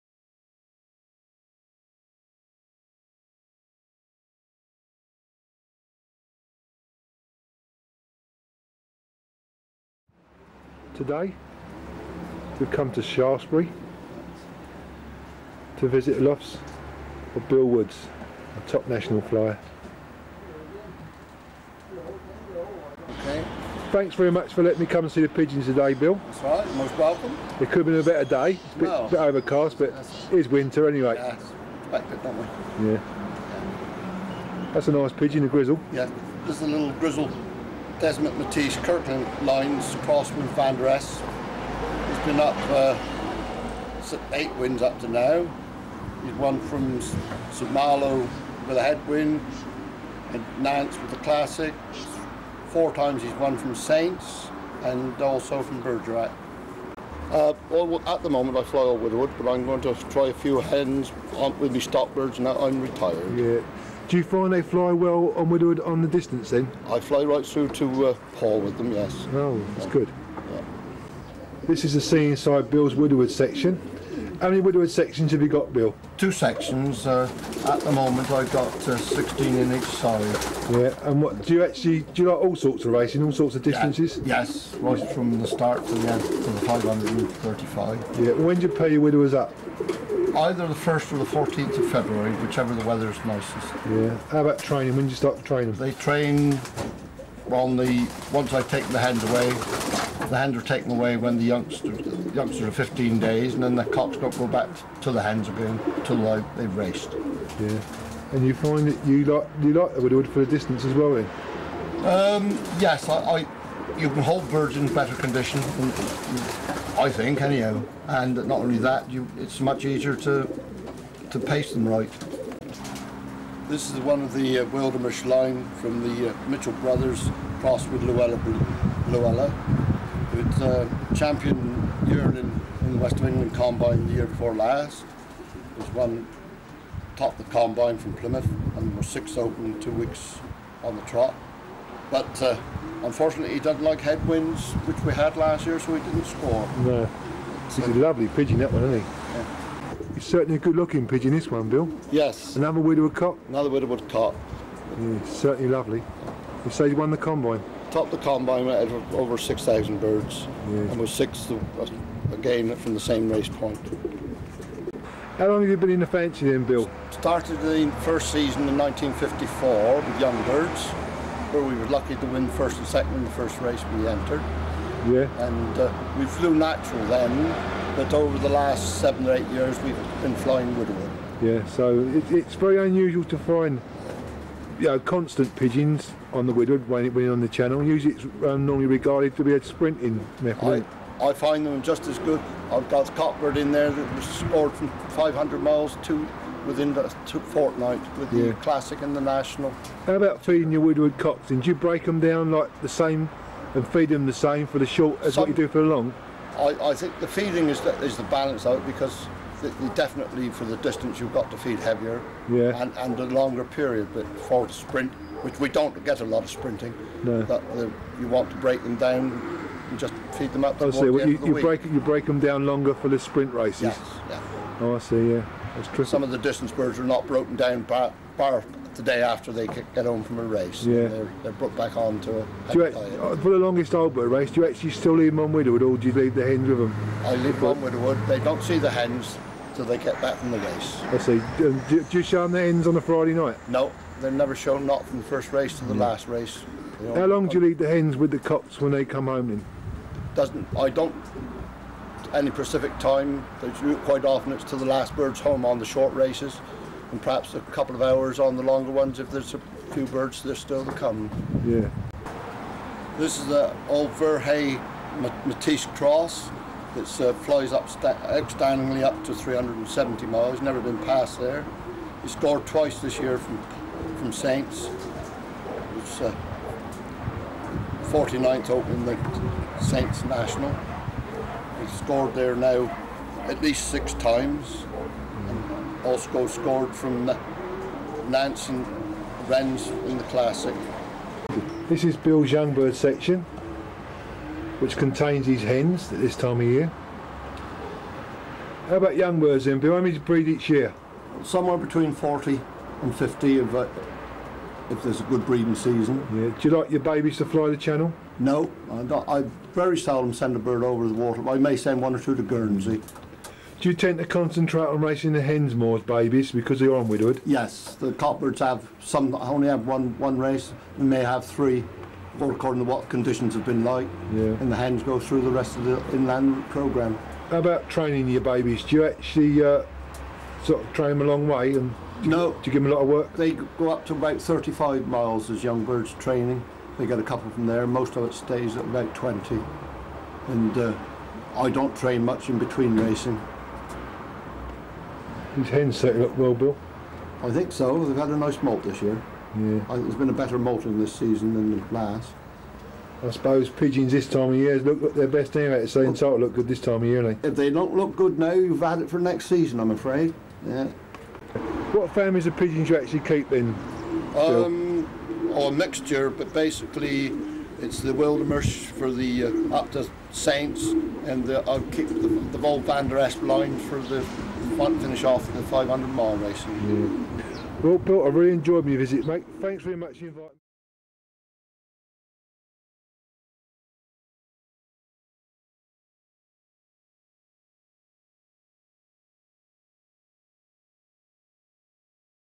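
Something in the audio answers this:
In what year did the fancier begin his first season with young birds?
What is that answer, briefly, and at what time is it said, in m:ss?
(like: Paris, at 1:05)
1954, at 2:48.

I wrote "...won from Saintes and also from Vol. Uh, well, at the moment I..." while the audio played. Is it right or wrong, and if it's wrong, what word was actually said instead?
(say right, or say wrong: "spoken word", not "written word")
wrong: "Bergerac", not "Vol".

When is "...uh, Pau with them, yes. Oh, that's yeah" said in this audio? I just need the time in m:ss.
1:08.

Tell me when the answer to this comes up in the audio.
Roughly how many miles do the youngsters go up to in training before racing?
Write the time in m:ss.
5:34.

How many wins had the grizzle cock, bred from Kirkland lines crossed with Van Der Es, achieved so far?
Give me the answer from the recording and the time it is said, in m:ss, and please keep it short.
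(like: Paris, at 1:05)
8, at 0:44.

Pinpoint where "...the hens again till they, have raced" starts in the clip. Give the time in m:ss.
1:45.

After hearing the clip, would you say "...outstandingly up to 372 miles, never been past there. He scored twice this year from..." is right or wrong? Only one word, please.
wrong.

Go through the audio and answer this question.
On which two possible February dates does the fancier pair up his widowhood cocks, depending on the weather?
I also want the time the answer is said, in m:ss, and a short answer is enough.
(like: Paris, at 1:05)
1st or 14th, at 1:30.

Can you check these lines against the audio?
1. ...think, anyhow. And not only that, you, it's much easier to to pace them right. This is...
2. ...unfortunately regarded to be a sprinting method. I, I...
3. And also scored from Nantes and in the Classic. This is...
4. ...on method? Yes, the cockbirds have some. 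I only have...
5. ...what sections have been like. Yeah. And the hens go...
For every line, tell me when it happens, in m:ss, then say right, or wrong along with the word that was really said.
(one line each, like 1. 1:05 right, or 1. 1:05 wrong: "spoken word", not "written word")
1. 1:57 right
2. 3:08 wrong: "normally", not "unfortunately"
3. 4:45 right
4. 5:16 wrong: "widowhood", not "method"
5. 5:22 wrong: "conditions", not "sections".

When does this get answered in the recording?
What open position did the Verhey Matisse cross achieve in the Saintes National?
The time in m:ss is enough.
4:38.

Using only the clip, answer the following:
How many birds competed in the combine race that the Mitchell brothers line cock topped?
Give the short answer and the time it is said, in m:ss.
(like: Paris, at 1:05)
over 6,000, at 2:39.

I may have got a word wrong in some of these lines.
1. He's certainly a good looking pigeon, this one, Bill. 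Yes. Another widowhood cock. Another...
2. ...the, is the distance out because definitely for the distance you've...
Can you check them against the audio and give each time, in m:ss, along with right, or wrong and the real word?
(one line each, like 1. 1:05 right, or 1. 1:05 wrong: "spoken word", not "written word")
1. 2:30 right
2. 3:27 wrong: "balance", not "distance".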